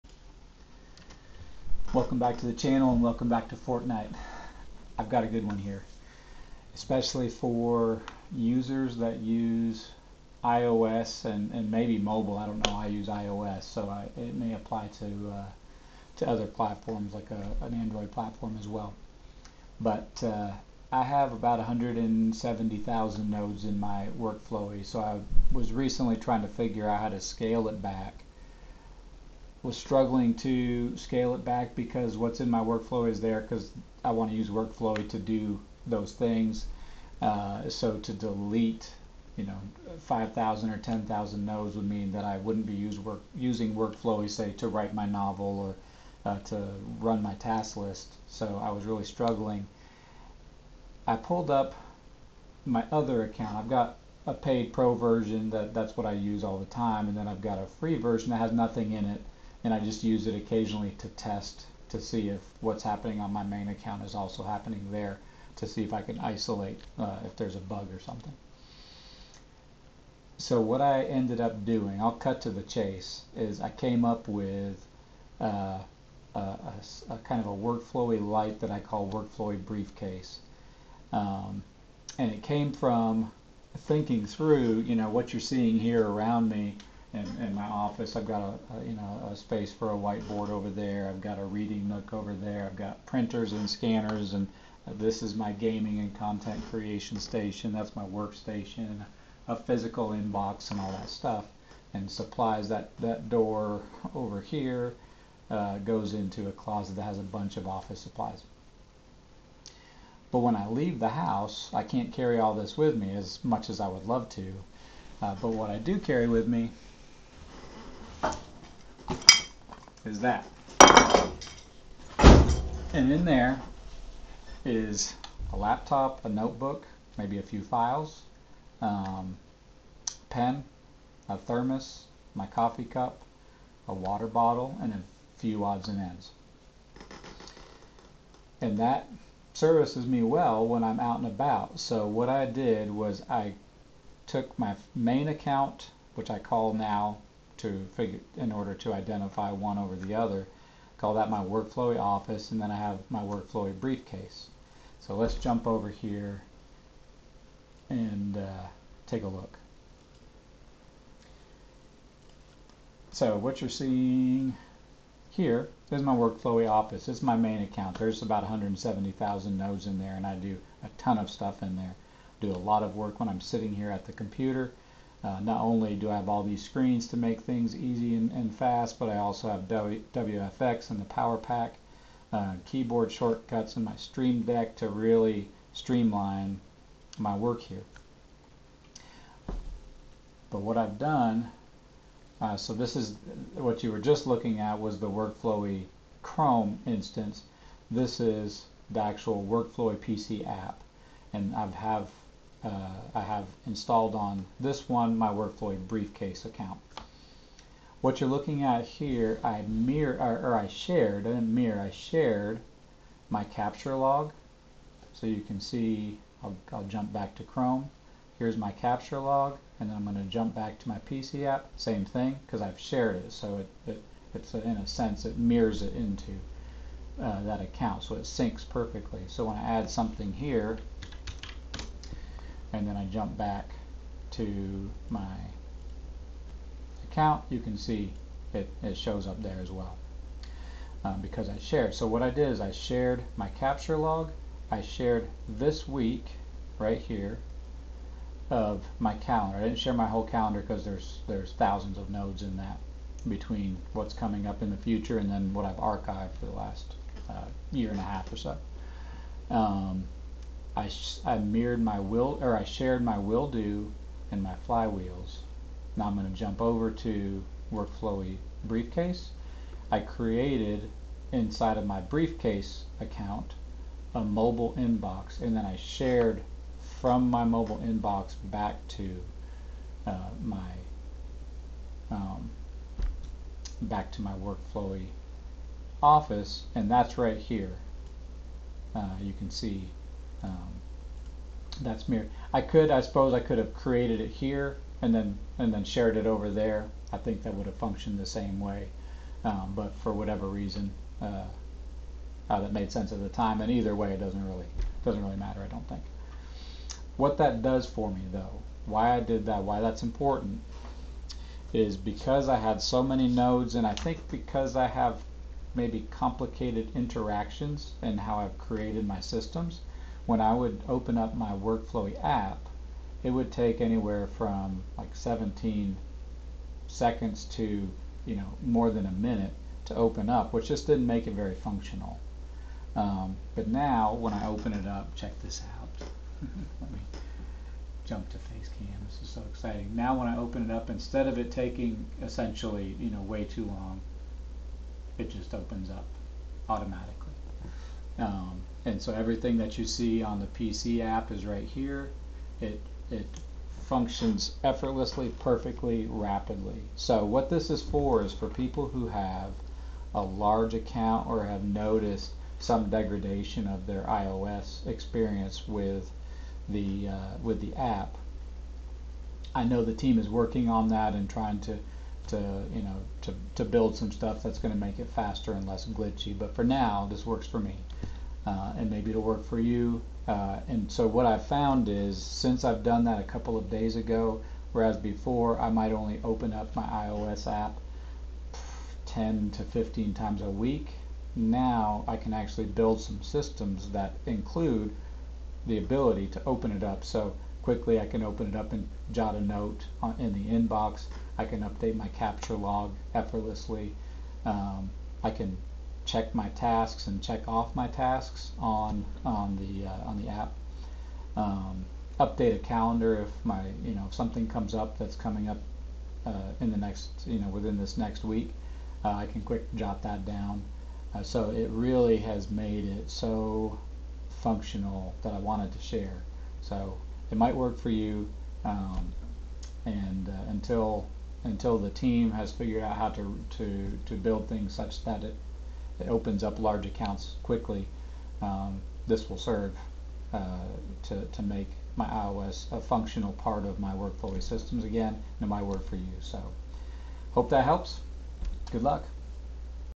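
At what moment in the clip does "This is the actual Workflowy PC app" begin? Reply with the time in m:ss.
3:17.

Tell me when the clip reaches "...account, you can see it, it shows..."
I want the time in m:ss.
3:57.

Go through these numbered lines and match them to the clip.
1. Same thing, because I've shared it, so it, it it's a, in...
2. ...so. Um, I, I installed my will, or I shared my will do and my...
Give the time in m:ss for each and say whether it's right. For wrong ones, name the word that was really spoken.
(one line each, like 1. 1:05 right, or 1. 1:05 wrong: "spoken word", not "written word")
1. 3:41 right
2. 4:18 wrong: "mirrored", not "installed".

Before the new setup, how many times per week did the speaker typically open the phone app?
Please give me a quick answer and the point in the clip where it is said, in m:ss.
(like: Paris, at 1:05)
10 to 15, at 6:29.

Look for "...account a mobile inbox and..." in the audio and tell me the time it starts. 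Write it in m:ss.
4:33.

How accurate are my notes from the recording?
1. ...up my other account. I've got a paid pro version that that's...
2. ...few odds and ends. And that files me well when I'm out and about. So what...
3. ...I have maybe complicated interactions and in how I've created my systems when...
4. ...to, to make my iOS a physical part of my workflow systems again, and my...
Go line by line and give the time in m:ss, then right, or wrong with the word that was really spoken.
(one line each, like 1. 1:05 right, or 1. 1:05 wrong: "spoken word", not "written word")
1. 0:51 right
2. 2:15 wrong: "services", not "files"
3. 5:14 right
4. 7:21 wrong: "functional", not "physical".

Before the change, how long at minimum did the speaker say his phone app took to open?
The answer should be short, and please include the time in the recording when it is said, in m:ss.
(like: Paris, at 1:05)
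17 seconds, at 5:25.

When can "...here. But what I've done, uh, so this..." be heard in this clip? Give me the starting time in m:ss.
3:07.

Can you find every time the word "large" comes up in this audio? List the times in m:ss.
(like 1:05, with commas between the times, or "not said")
6:00, 7:16.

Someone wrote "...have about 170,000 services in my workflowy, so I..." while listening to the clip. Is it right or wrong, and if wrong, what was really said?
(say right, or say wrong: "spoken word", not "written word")
wrong: "nodes", not "services".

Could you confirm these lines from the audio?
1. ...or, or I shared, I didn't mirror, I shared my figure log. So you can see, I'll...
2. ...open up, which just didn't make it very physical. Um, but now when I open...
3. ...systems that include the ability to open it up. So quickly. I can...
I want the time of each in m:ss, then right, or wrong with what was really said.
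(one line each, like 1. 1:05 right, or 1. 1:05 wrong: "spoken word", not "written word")
1. 3:30 wrong: "capture", not "figure"
2. 5:29 wrong: "functional", not "physical"
3. 6:33 right.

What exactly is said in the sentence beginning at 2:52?
Do a lot of work when I'm sitting here at the computer.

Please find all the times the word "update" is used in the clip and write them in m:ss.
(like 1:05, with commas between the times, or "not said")
6:41, 6:52.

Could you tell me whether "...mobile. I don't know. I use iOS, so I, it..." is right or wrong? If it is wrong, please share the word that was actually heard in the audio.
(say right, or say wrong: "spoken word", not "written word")
right.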